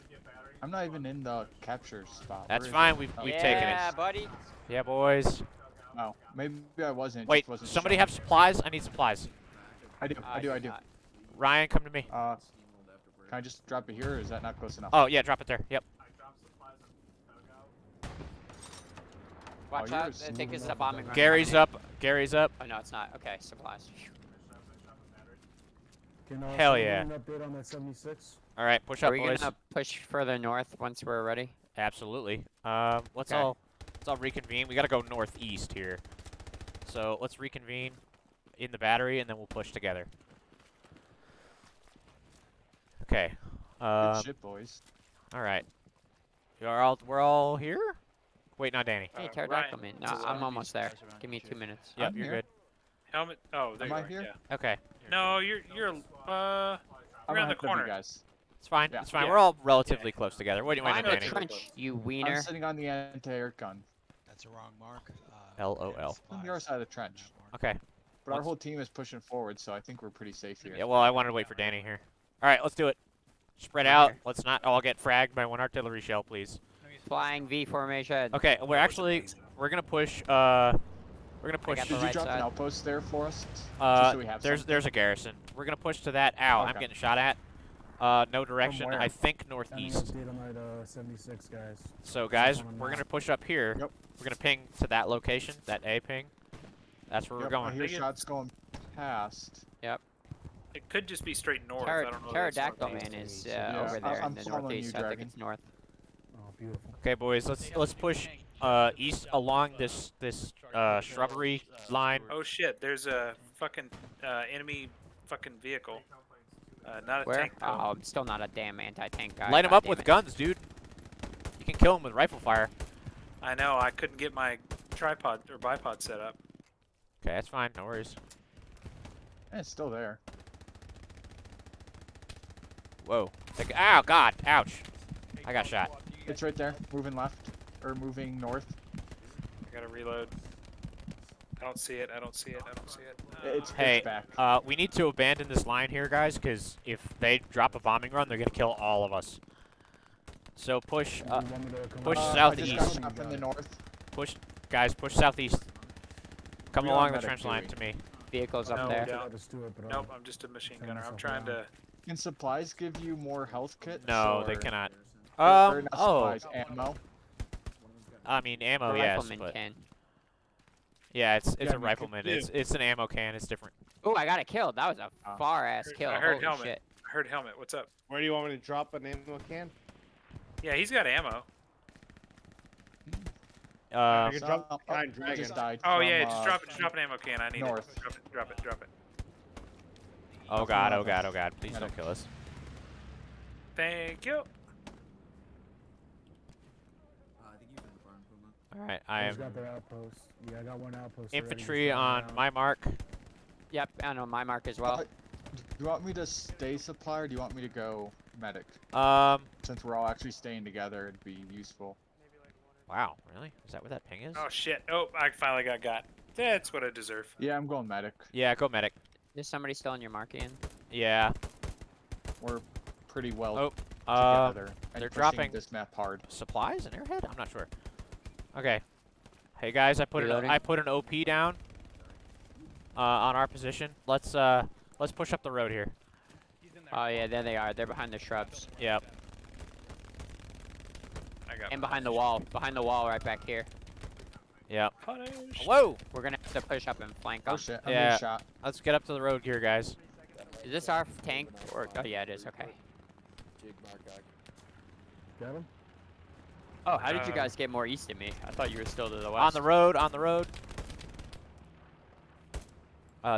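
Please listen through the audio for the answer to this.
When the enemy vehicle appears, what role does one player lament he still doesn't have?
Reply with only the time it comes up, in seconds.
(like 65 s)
118 s.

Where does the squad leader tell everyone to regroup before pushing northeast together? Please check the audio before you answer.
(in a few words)
the battery.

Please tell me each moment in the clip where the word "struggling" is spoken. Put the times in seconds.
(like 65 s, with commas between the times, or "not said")
not said.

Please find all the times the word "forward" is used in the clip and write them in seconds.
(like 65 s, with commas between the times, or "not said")
69 s.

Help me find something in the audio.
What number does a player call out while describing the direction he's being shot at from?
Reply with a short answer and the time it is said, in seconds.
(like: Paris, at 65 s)
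76, at 90 s.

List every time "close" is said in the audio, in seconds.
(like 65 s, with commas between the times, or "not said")
14 s, 60 s.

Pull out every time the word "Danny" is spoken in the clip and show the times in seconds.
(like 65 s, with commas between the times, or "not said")
48 s, 71 s.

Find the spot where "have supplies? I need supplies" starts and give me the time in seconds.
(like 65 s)
8 s.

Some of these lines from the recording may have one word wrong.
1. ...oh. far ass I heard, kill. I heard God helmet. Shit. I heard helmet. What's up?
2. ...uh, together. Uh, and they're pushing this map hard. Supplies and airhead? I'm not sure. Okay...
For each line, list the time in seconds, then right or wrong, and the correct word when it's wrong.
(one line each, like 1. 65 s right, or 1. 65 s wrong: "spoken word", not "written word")
1. 175 s wrong: "Holy", not "God"
2. 224 s wrong: "dropping", not "pushing".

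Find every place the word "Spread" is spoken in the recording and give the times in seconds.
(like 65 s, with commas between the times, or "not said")
73 s.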